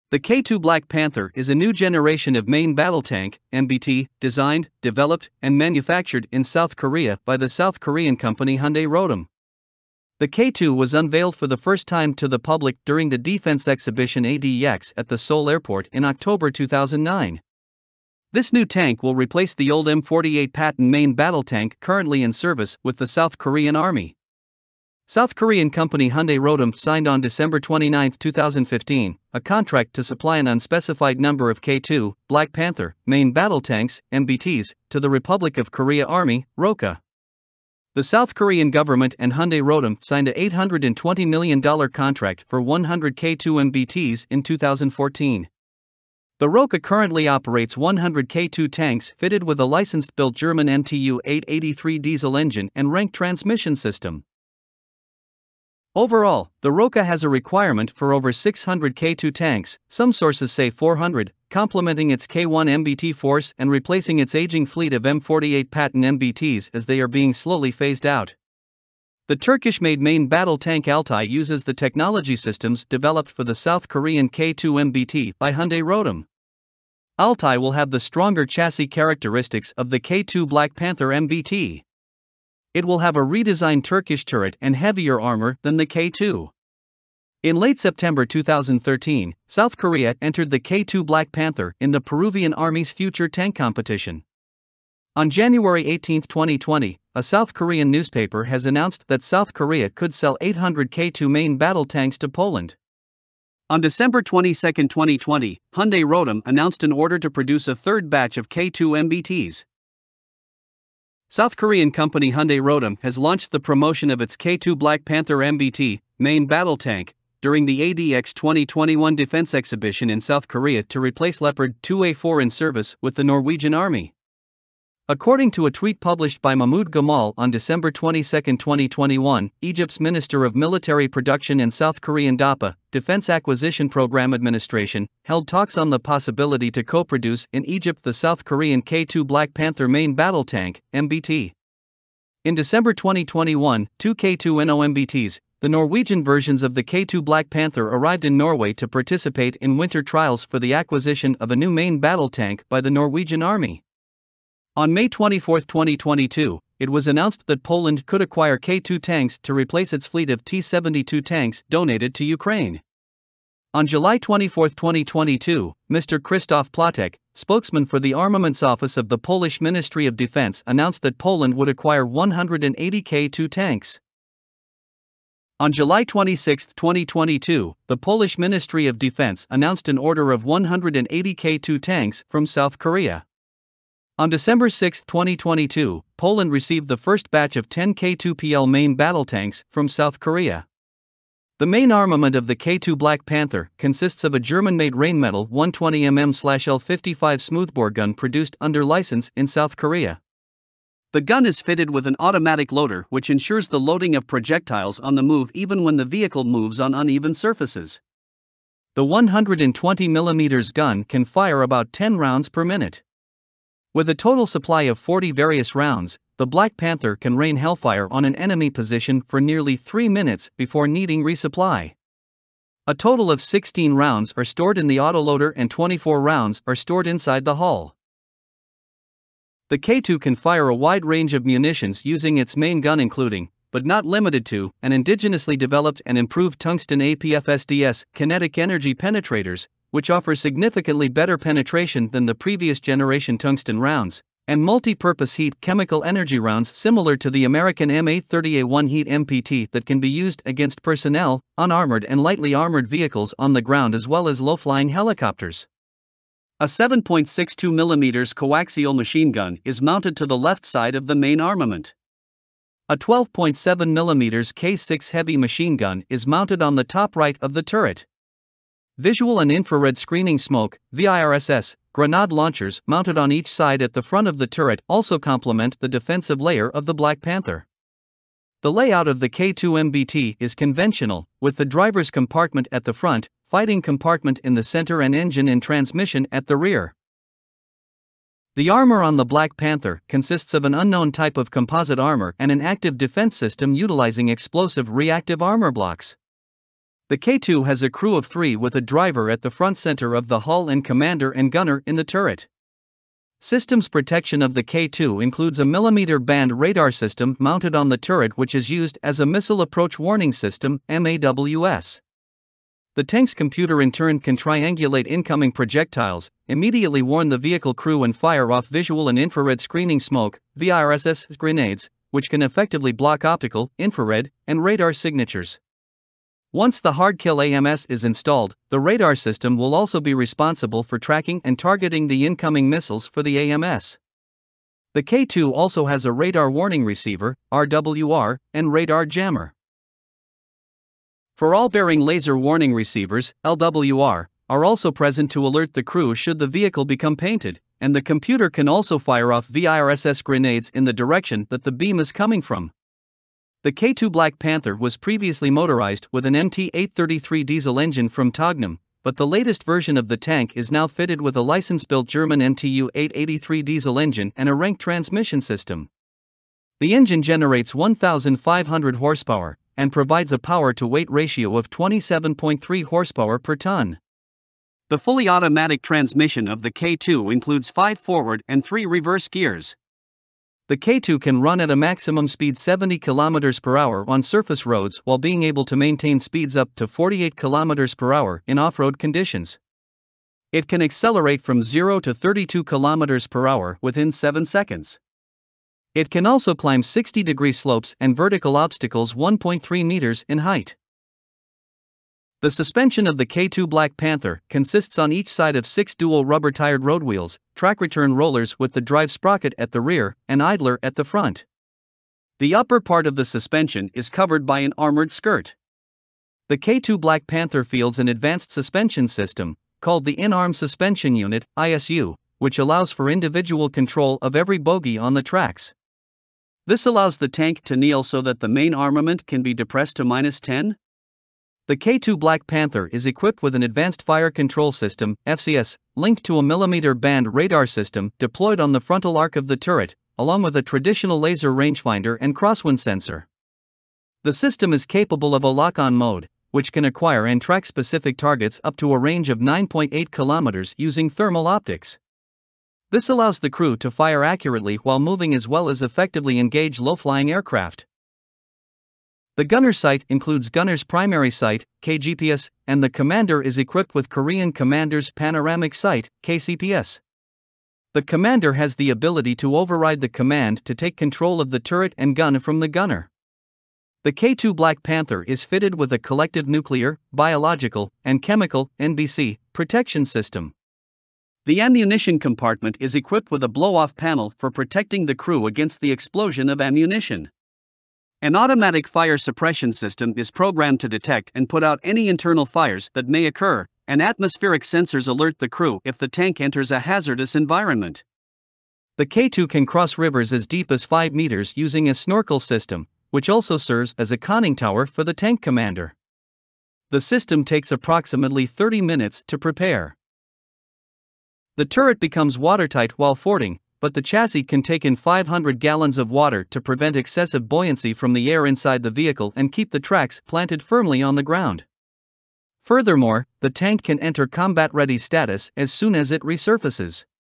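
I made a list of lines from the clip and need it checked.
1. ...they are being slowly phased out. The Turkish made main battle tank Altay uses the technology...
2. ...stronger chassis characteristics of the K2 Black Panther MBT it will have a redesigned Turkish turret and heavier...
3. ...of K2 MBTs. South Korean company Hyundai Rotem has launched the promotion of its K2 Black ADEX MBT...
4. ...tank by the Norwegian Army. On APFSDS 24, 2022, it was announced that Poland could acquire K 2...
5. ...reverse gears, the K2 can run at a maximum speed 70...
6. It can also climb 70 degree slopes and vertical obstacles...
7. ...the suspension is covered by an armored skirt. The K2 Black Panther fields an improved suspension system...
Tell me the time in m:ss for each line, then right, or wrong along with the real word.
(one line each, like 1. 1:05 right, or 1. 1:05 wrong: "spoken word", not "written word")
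1. 1:06 right
2. 1:17 right
3. 1:48 wrong: "Panther", not "ADEX"
4. 2:32 wrong: "May", not "APFSDS"
5. 6:18 right
6. 6:35 wrong: "60", not "70"
7. 6:53 wrong: "advanced", not "improved".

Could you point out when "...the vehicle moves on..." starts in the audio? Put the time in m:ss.
3:25.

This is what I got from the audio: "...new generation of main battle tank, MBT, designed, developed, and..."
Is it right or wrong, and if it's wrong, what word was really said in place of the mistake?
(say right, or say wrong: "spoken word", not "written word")
right.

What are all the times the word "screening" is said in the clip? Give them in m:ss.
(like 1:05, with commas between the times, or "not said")
4:29, 5:19.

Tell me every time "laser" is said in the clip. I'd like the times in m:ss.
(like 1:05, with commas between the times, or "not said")
5:42, 7:21.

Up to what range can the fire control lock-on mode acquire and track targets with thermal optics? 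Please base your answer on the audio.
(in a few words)
9.8 kilometers.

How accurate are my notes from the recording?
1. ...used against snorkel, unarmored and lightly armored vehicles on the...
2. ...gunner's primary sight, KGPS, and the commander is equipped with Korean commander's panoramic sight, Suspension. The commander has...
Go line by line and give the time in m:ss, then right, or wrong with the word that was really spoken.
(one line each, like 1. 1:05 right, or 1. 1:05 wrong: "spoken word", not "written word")
1. 4:10 wrong: "personnel", not "snorkel"
2. 7:40 wrong: "KCPS", not "Suspension".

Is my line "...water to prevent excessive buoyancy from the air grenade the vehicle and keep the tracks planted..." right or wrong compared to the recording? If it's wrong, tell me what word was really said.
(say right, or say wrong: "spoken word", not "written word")
wrong: "inside", not "grenade".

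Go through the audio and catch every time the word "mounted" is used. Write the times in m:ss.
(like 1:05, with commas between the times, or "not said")
4:19, 4:26, 4:32, 5:07.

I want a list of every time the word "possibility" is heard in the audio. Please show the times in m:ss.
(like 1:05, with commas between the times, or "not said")
2:15.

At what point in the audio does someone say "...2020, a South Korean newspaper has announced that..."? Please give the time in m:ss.
1:36.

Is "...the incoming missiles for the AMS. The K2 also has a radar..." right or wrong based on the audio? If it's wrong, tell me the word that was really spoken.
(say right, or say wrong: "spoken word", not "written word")
right.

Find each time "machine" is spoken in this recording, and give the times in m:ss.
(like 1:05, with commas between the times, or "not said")
4:18, 4:25.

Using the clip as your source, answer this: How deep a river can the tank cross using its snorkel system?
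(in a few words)
5 meters.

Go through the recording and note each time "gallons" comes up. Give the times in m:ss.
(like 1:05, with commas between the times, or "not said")
8:35.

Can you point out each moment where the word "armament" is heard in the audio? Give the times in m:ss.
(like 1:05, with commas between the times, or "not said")
2:48, 3:11, 4:21, 7:08.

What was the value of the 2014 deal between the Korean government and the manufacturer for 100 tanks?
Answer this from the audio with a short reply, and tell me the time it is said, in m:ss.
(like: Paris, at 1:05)
$820 million, at 0:40.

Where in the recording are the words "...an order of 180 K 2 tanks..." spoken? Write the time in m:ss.
2:59.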